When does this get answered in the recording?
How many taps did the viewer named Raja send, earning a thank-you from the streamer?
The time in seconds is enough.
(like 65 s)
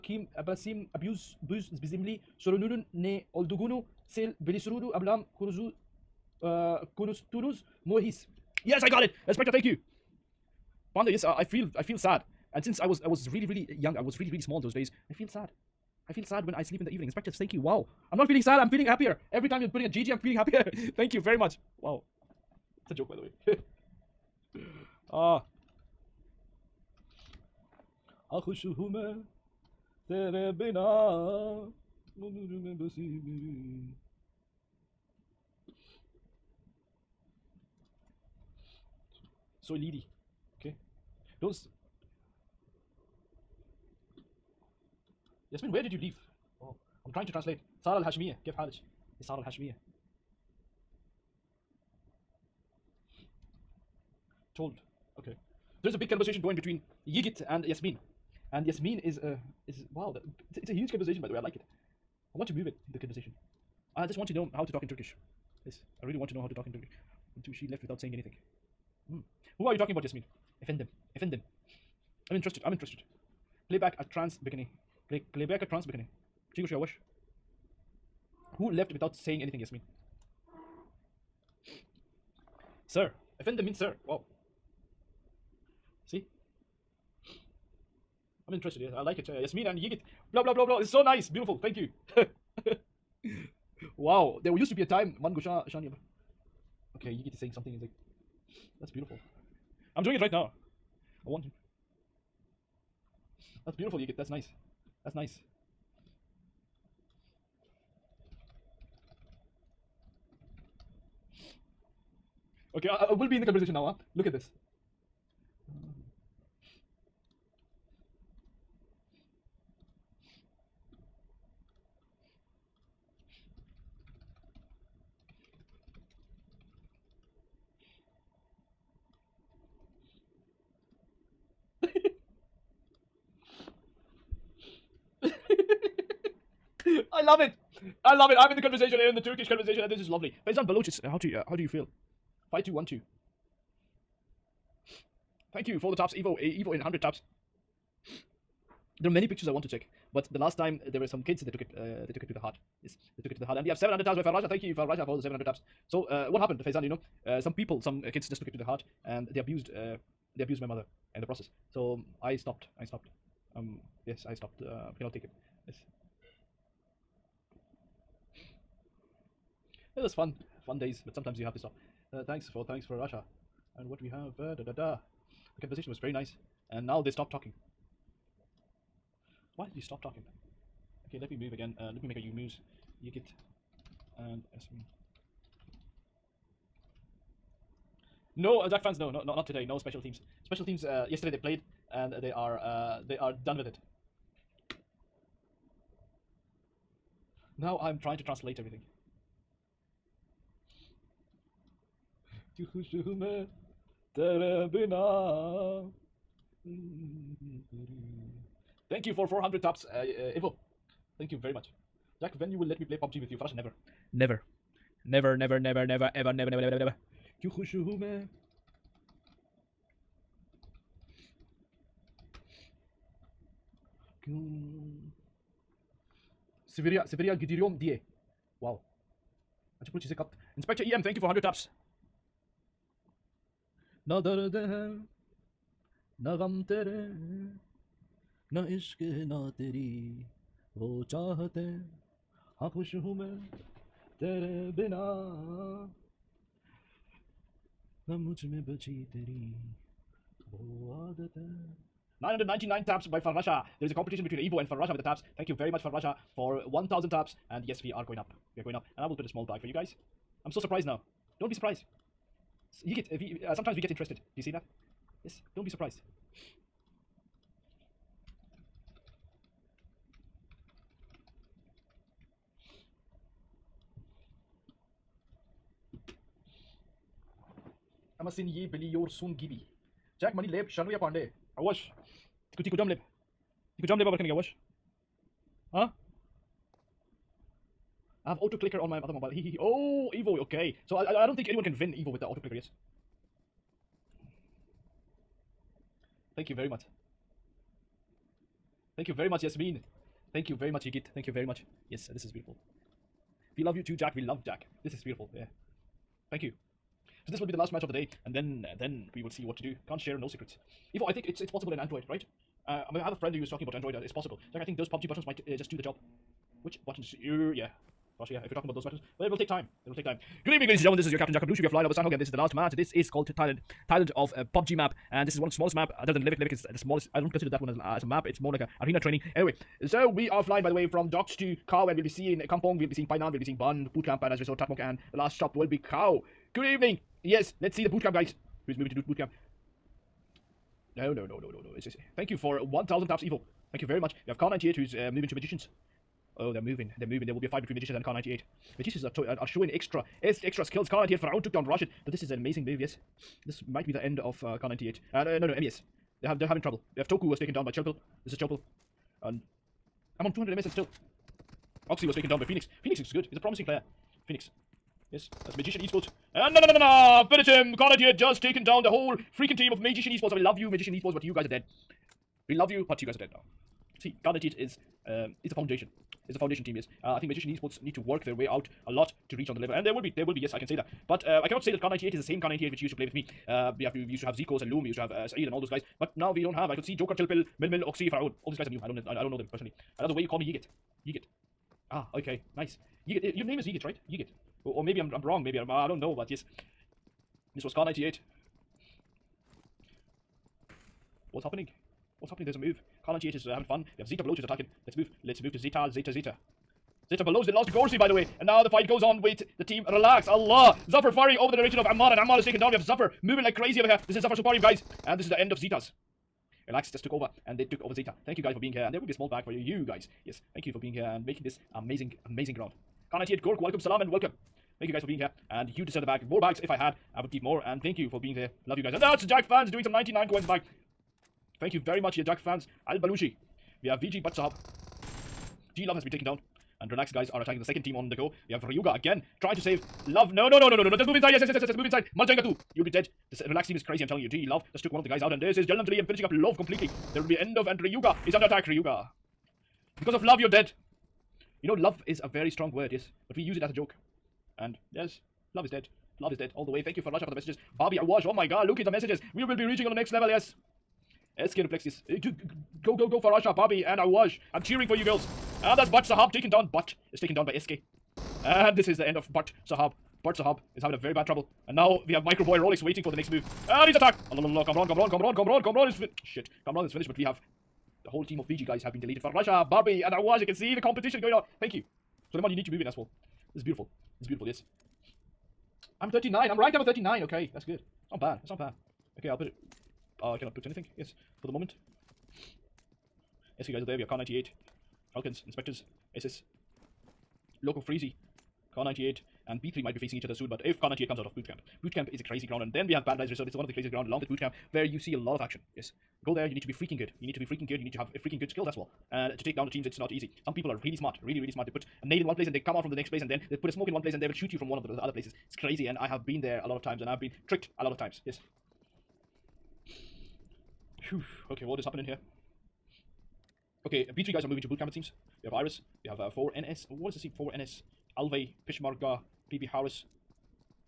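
153 s.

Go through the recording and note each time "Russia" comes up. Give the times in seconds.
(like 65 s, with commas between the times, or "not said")
172 s, 318 s, 479 s.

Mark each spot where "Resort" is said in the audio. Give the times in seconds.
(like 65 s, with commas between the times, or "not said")
334 s, 503 s.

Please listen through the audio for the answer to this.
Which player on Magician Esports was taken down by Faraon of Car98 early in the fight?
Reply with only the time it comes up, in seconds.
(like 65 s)
351 s.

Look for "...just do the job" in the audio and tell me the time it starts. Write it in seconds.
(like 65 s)
315 s.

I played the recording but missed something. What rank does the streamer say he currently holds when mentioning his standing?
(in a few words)
39.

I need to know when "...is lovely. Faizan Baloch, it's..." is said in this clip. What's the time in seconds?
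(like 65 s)
139 s.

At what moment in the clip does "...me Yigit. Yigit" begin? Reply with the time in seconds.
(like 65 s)
390 s.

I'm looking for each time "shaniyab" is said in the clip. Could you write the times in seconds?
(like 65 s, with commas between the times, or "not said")
95 s.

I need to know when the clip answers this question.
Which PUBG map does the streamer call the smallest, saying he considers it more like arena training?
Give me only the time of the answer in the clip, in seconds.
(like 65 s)
326 s.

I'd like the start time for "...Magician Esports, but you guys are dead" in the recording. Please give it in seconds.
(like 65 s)
370 s.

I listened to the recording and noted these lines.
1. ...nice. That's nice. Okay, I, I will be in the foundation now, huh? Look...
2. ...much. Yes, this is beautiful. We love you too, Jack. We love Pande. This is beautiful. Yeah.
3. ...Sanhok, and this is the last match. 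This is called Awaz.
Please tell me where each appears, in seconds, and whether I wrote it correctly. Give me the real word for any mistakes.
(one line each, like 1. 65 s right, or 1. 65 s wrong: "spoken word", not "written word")
1. 104 s wrong: "conversation", not "foundation"
2. 301 s wrong: "Jack", not "Pande"
3. 321 s wrong: "Thailand", not "Awaz".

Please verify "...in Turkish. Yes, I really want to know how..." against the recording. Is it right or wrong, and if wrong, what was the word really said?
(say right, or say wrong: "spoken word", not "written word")
right.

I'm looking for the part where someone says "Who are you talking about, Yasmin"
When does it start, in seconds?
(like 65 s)
69 s.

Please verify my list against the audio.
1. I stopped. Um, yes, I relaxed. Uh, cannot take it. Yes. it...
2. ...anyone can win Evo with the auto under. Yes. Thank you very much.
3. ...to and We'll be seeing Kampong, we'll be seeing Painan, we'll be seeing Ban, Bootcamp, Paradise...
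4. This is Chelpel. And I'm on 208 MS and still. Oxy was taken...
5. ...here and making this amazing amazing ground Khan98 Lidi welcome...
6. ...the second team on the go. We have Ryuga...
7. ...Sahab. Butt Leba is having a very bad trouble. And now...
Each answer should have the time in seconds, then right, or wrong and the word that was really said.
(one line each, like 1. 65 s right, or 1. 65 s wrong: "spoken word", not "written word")
1. 162 s wrong: "stopped", not "relaxed"
2. 291 s wrong: "clicker", not "under"
3. 331 s right
4. 358 s wrong: "200", not "208"
5. 420 s wrong: "Gork", not "Lidi"
6. 437 s right
7. 469 s wrong: "Sahab", not "Leba".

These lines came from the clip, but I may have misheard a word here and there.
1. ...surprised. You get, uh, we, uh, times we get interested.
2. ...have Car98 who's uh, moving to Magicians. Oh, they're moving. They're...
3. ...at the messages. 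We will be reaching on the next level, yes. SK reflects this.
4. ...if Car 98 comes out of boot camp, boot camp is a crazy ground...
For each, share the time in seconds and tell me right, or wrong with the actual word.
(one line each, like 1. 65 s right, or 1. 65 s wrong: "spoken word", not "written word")
1. 261 s wrong: "sometimes", not "times"
2. 344 s right
3. 458 s right
4. 500 s right.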